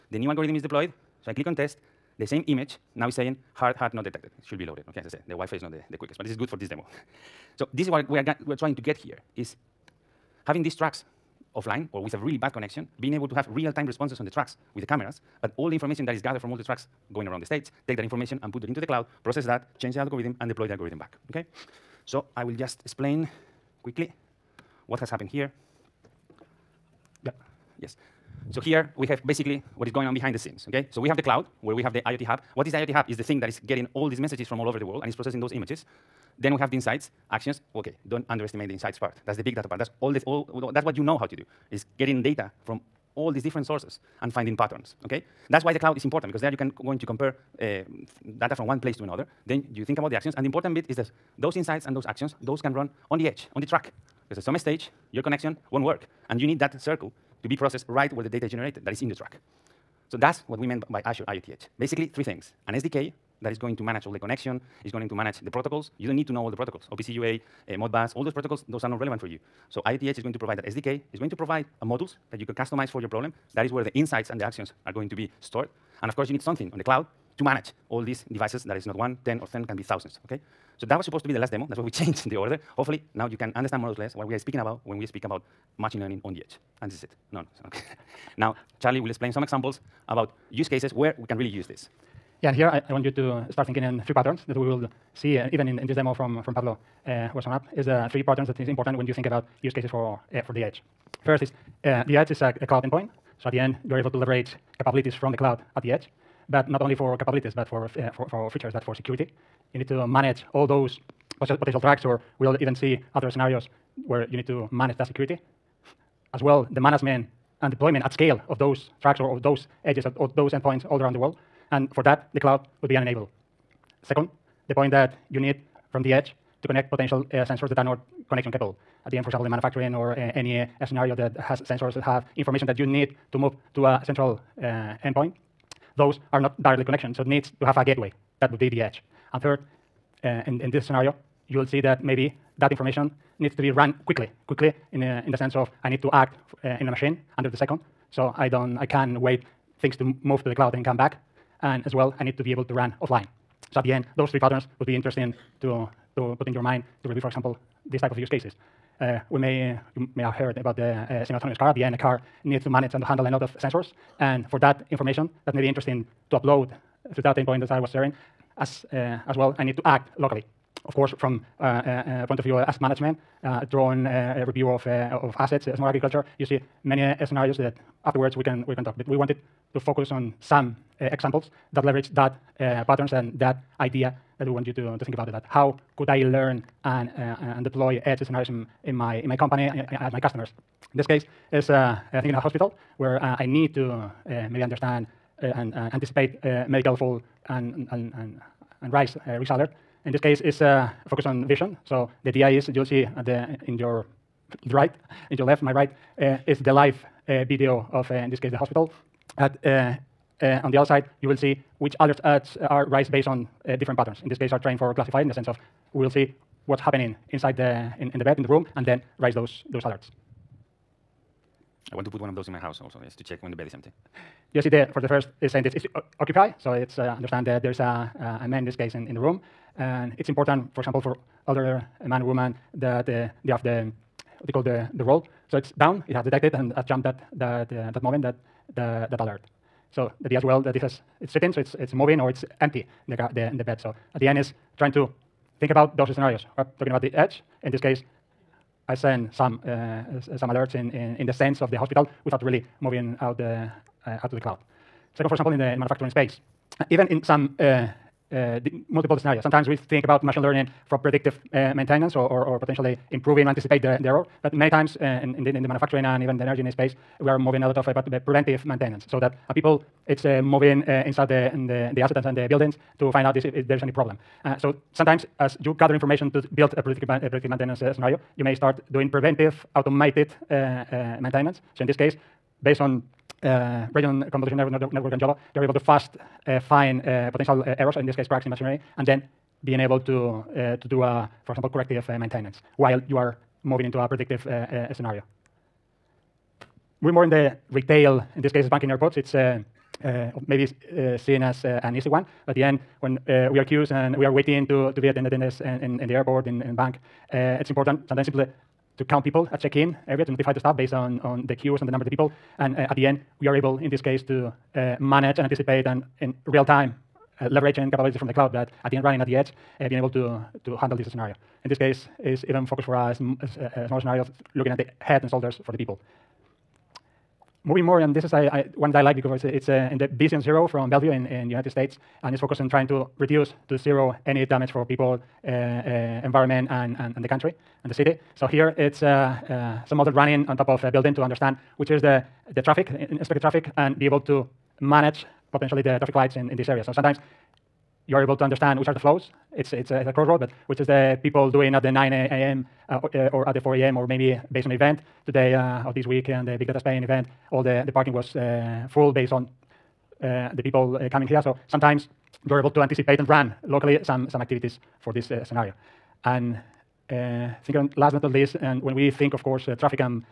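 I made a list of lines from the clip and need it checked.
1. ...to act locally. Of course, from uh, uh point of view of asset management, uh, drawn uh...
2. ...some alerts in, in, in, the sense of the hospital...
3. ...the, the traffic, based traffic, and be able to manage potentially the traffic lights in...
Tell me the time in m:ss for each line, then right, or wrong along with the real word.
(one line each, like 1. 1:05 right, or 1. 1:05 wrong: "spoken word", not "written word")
1. 2:49 right
2. 4:10 right
3. 5:42 wrong: "expected", not "based".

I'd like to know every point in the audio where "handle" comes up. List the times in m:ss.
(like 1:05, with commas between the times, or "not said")
2:43, 5:20.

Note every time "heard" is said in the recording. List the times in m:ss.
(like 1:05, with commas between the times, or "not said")
2:40.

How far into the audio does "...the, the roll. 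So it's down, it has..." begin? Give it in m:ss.
3:54.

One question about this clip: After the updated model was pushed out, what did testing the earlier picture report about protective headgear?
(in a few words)
Hard hat not detected.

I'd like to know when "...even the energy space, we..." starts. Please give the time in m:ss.
4:26.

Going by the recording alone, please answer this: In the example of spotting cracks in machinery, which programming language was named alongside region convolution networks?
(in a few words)
Java.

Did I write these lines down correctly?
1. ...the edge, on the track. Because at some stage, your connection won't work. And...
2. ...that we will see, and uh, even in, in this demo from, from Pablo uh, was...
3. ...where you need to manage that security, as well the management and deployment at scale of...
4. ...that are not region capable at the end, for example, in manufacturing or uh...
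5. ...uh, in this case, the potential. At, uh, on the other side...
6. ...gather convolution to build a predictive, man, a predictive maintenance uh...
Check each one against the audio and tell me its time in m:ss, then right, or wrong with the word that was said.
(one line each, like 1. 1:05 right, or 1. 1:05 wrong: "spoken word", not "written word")
1. 0:53 right
2. 1:34 right
3. 1:54 right
4. 2:07 wrong: "connection", not "region"
5. 3:28 wrong: "hospital", not "potential"
6. 4:35 wrong: "information", not "convolution".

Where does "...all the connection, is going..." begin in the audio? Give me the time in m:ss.
1:04.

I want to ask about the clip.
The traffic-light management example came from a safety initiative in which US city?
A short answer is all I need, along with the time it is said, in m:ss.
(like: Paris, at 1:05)
Bellevue, at 5:30.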